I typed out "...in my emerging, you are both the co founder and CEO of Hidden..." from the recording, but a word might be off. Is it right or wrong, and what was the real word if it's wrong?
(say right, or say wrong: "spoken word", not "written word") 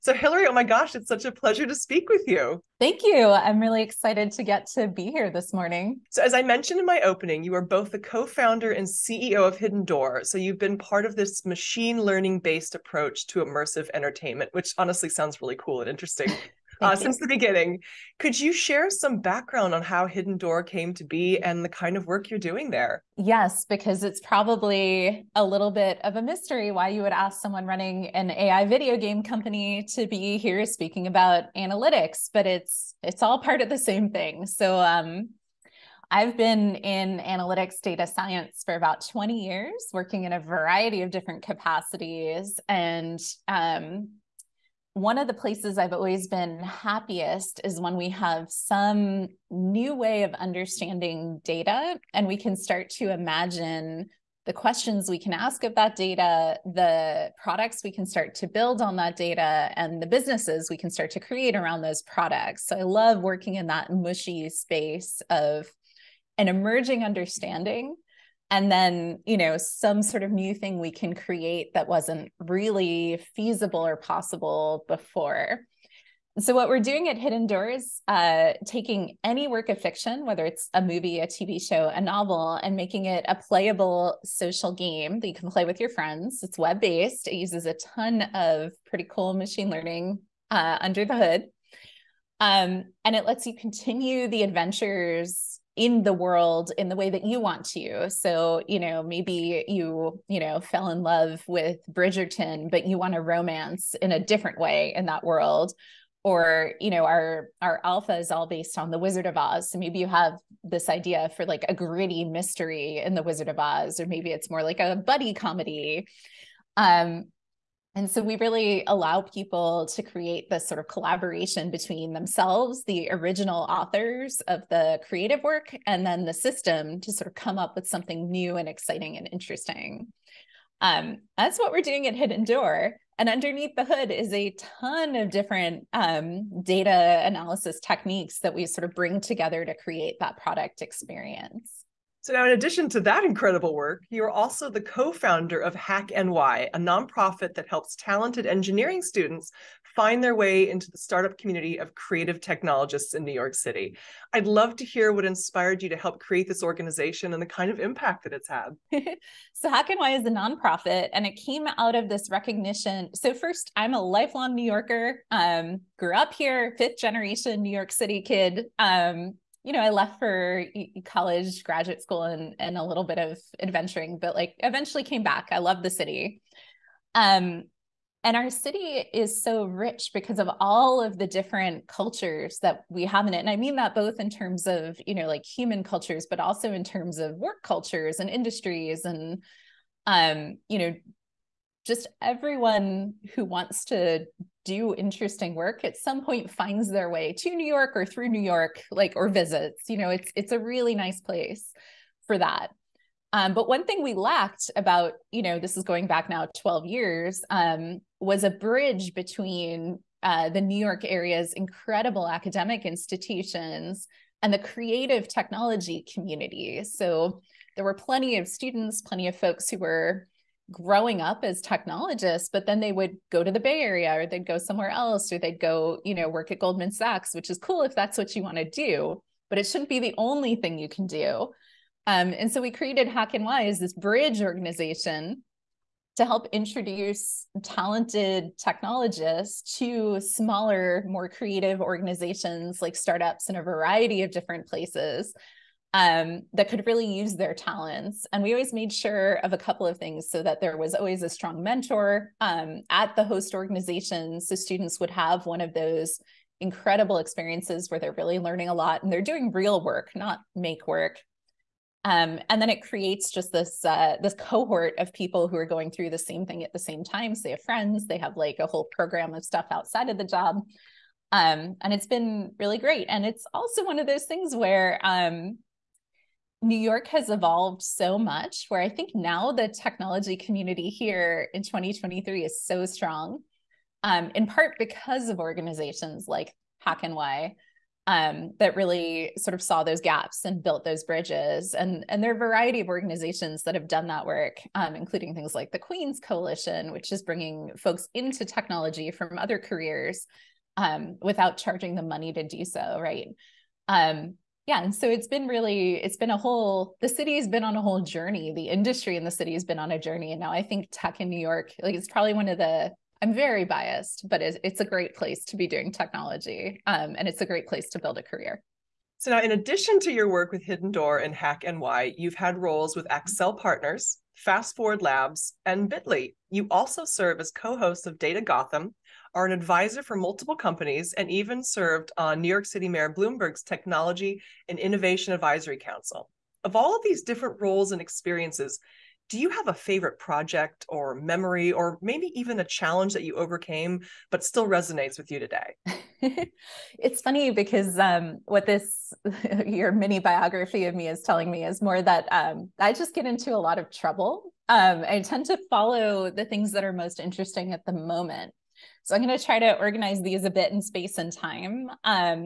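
wrong: "opening", not "emerging".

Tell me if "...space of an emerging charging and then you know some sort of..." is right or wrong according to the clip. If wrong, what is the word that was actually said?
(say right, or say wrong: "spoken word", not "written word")
wrong: "understanding", not "charging".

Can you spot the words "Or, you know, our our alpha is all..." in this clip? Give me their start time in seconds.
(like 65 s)
106 s.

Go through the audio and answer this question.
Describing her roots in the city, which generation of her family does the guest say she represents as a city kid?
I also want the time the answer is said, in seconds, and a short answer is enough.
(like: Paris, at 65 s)
Fifth, at 166 s.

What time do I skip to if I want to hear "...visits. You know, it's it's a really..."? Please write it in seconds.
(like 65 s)
199 s.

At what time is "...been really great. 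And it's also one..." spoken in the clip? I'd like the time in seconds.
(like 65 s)
272 s.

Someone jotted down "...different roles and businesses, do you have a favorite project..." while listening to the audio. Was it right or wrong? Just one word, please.
wrong.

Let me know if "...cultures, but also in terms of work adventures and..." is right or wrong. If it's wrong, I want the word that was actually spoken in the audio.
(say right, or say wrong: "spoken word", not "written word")
wrong: "cultures", not "adventures".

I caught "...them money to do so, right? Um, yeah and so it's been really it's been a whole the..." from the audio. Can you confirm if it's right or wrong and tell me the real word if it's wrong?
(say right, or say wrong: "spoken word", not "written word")
right.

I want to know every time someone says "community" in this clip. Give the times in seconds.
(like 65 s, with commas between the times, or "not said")
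151 s, 216 s, 280 s.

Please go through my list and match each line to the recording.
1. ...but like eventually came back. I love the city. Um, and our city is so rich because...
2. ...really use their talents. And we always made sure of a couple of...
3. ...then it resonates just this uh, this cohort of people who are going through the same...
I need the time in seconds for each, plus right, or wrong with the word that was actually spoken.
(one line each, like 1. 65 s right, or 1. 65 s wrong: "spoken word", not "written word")
1. 174 s right
2. 246 s right
3. 262 s wrong: "creates", not "resonates".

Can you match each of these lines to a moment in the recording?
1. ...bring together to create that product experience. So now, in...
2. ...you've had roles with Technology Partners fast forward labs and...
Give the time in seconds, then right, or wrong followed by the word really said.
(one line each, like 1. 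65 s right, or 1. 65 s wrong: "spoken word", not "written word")
1. 138 s right
2. 322 s wrong: "Accel", not "Technology".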